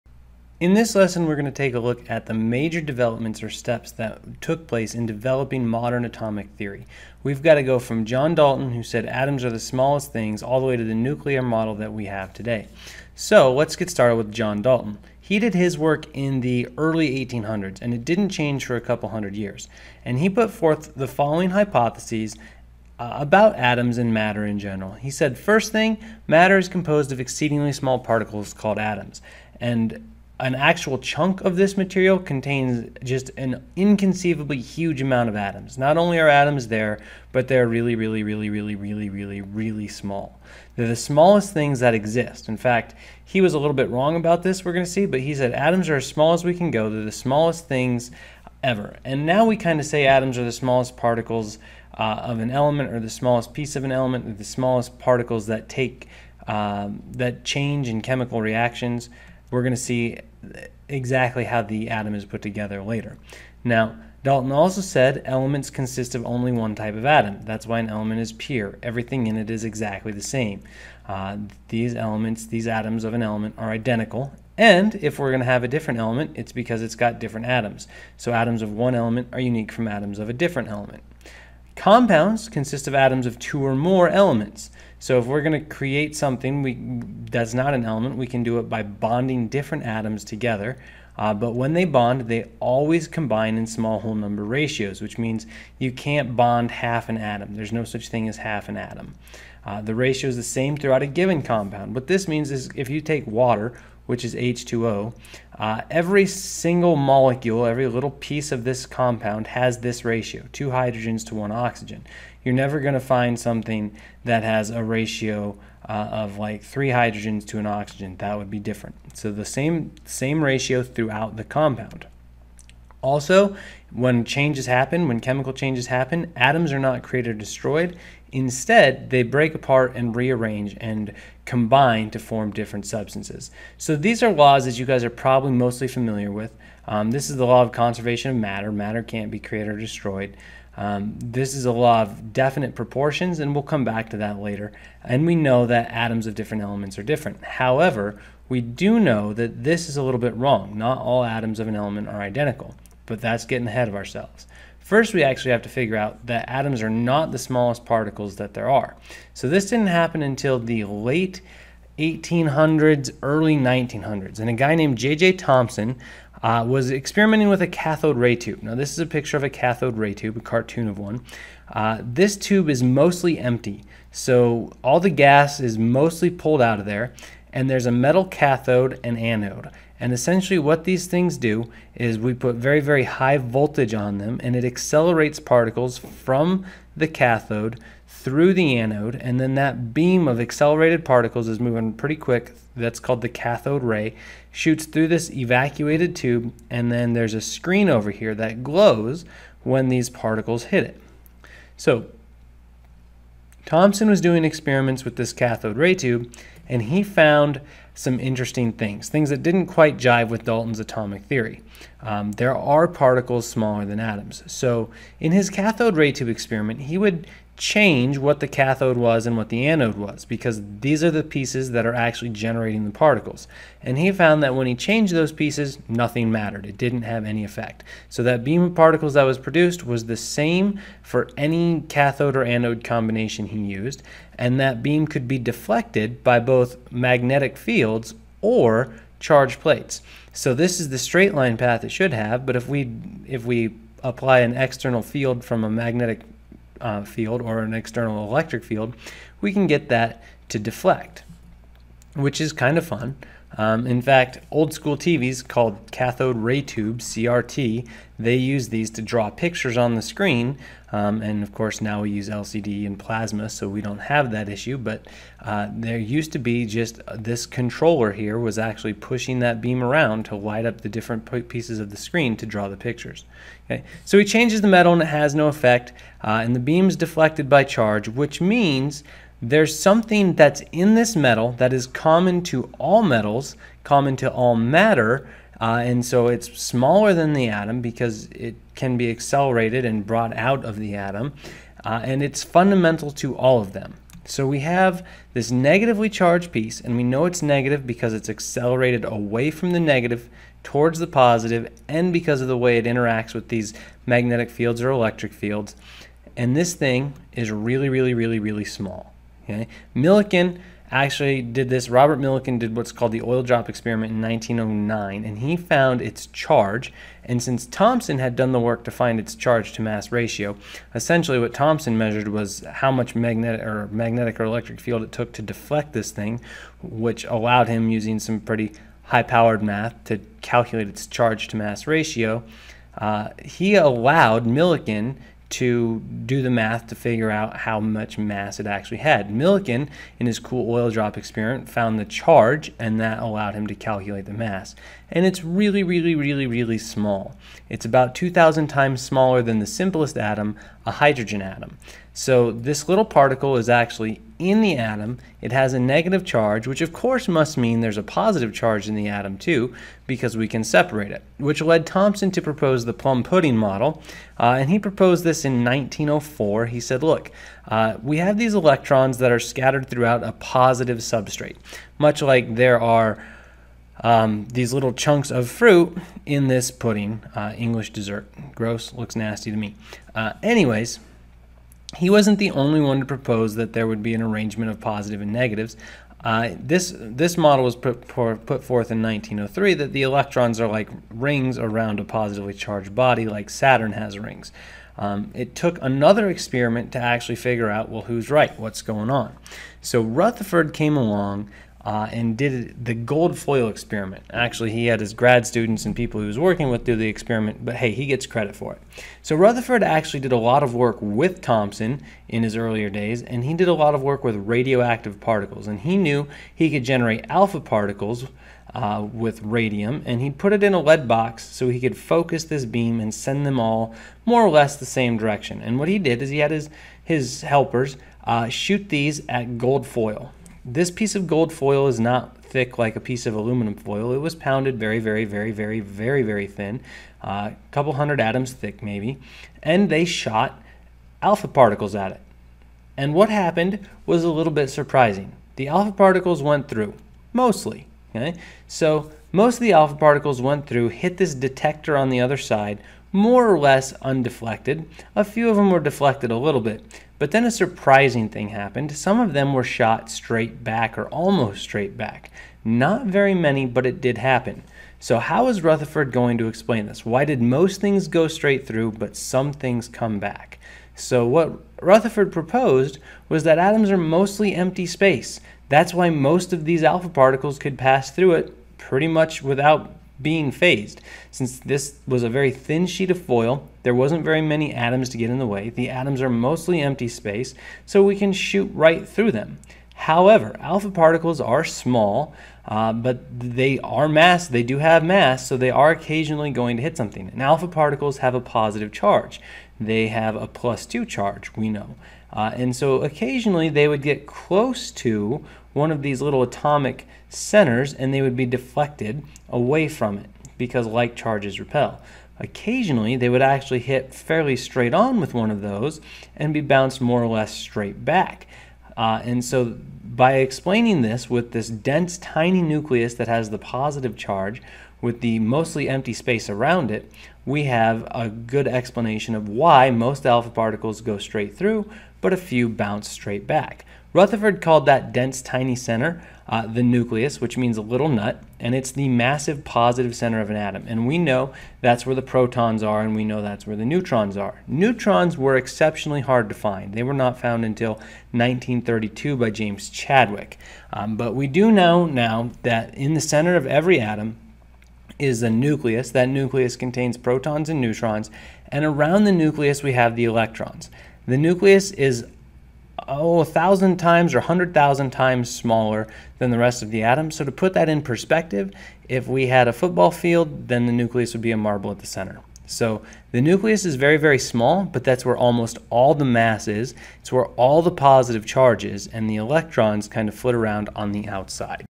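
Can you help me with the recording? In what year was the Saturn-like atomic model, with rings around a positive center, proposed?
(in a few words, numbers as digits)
1903.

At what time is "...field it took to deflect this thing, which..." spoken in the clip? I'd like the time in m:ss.
5:24.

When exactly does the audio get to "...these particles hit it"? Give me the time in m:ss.
3:19.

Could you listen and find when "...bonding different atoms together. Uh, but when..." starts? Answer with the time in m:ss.
1:28.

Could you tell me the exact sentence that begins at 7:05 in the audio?
And what he did is he had his, his helpers uh, shoot these at gold foil.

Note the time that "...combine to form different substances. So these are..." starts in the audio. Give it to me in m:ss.
2:11.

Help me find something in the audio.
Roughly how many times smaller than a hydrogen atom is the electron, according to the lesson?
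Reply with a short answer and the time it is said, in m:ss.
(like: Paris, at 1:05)
2,000, at 5:48.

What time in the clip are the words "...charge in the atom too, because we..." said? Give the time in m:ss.
5:58.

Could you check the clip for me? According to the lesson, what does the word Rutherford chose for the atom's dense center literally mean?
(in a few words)
A little nut.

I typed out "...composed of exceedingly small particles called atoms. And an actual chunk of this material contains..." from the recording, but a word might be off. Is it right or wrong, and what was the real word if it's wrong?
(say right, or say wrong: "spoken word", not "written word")
right.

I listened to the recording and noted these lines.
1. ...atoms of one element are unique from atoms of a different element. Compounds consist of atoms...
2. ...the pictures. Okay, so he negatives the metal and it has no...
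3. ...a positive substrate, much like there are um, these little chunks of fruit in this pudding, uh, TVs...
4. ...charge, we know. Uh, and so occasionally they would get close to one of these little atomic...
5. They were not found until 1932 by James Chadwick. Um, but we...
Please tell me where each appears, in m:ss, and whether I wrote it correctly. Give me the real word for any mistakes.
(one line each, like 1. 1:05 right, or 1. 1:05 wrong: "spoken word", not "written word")
1. 1:18 right
2. 4:32 wrong: "changes", not "negatives"
3. 6:10 wrong: "English", not "TVs"
4. 8:21 right
5. 9:06 right.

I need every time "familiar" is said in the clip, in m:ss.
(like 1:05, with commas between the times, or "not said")
2:15.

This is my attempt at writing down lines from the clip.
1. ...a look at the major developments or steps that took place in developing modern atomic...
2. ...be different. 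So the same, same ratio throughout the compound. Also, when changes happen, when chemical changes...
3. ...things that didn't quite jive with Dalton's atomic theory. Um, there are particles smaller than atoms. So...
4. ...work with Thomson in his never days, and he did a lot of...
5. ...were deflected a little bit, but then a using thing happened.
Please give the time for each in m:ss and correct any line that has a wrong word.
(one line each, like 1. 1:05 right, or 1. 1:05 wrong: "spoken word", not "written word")
1. 0:01 right
2. 1:58 right
3. 3:29 right
4. 6:50 wrong: "earlier", not "never"
5. 7:35 wrong: "surprising", not "using".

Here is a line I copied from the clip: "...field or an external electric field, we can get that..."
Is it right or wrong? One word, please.
right.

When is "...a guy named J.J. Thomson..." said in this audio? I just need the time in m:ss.
2:44.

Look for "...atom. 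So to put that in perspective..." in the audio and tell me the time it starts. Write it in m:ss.
9:27.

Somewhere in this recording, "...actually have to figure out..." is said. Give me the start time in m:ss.
2:35.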